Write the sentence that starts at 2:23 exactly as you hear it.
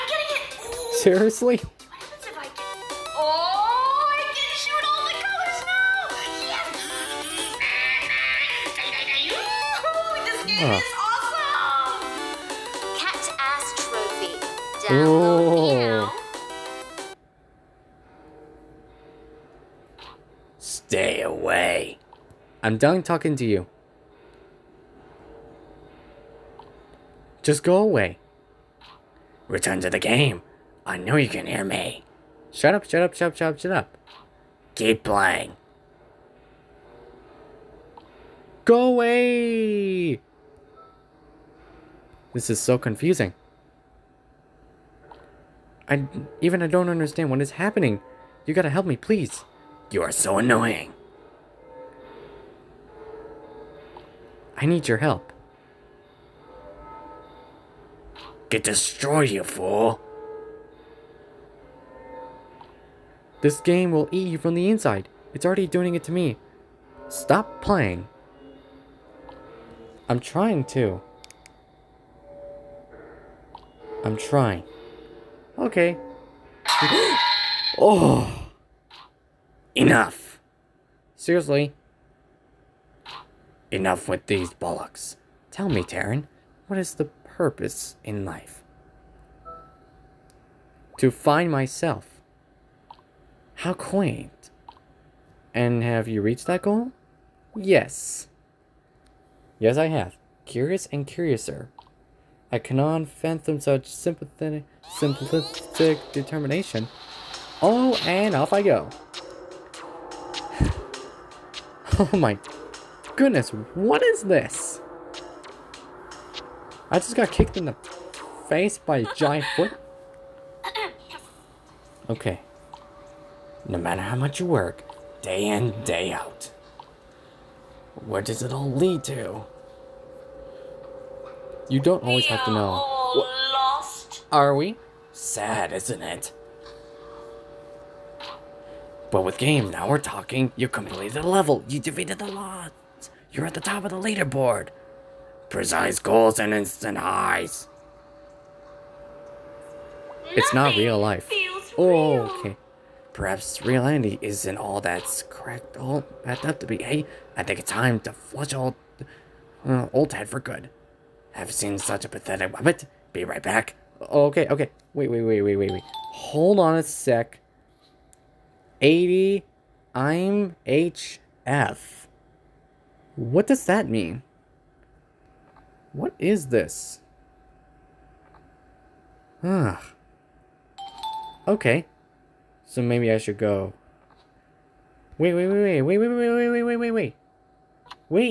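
You're at the top of the leaderboard.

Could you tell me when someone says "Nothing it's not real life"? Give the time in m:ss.
2:30.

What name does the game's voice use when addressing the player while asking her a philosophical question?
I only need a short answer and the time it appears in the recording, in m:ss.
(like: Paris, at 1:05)
Taryn, at 1:25.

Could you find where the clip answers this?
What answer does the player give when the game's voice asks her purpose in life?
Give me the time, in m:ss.
1:30.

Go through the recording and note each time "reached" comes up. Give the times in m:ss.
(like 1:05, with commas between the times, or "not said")
1:36.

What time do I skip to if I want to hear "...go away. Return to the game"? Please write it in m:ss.
0:27.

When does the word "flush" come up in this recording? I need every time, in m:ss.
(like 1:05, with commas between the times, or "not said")
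2:38.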